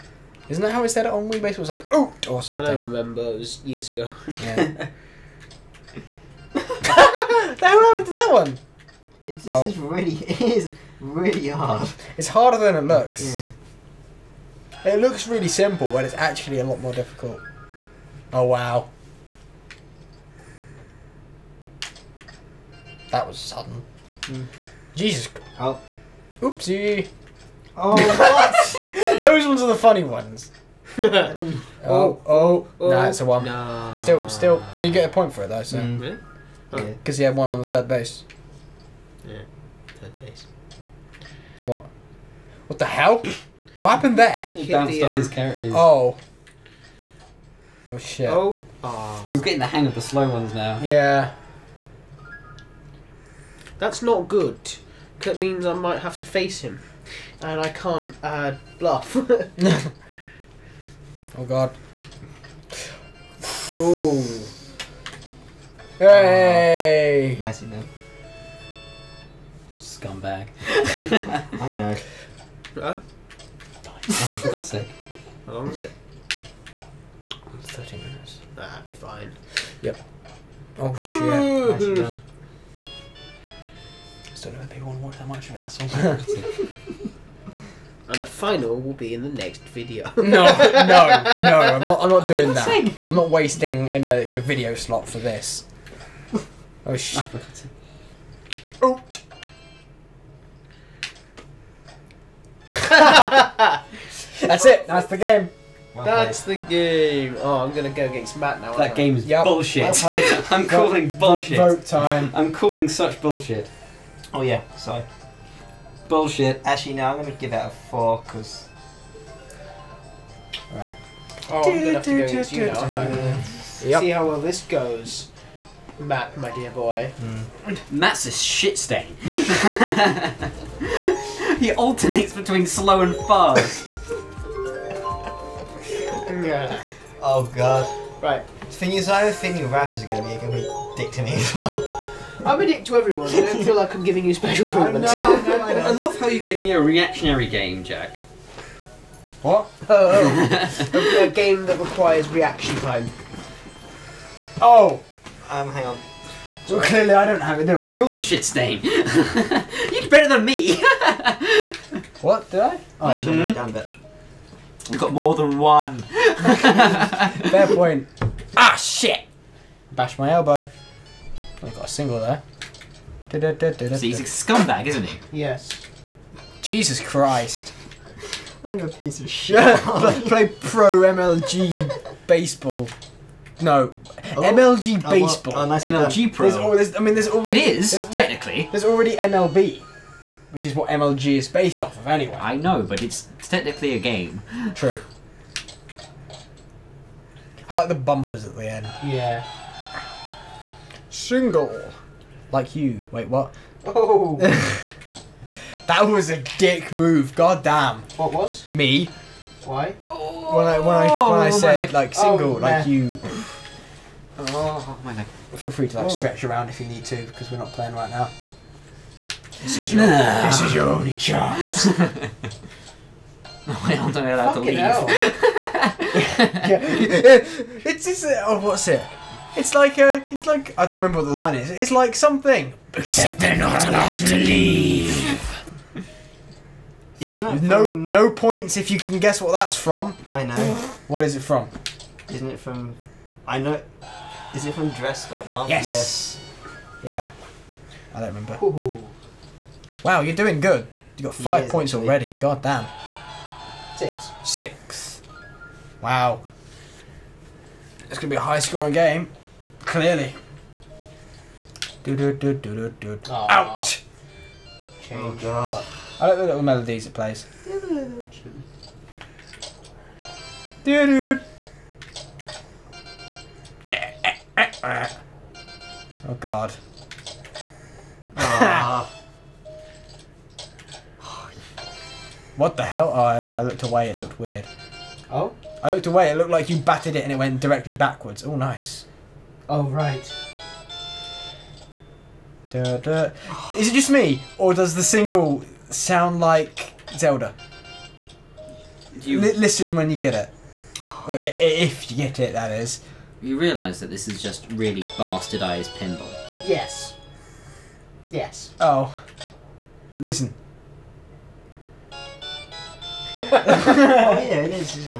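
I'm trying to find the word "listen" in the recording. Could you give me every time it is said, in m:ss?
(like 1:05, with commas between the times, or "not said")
4:59, 5:10.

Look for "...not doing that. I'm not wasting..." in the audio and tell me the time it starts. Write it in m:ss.
1:32.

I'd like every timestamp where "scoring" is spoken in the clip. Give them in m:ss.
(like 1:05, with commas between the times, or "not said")
4:18.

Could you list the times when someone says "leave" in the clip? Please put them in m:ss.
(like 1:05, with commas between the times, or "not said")
3:44, 3:54.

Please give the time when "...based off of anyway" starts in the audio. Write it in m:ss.
3:11.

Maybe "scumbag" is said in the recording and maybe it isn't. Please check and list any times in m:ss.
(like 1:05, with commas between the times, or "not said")
1:09, 2:54.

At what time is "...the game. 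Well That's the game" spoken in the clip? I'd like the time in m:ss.
1:45.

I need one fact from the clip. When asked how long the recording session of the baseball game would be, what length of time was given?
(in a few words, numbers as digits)
30 minutes.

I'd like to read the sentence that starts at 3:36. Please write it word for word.
stretch around if you need to because we're not playing right now.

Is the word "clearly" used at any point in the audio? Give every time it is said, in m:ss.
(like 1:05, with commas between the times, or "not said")
2:36, 4:19.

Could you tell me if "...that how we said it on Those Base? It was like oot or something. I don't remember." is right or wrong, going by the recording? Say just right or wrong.
wrong.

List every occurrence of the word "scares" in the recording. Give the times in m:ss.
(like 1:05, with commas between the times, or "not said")
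not said.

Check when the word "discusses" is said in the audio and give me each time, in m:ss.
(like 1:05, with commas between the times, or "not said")
not said.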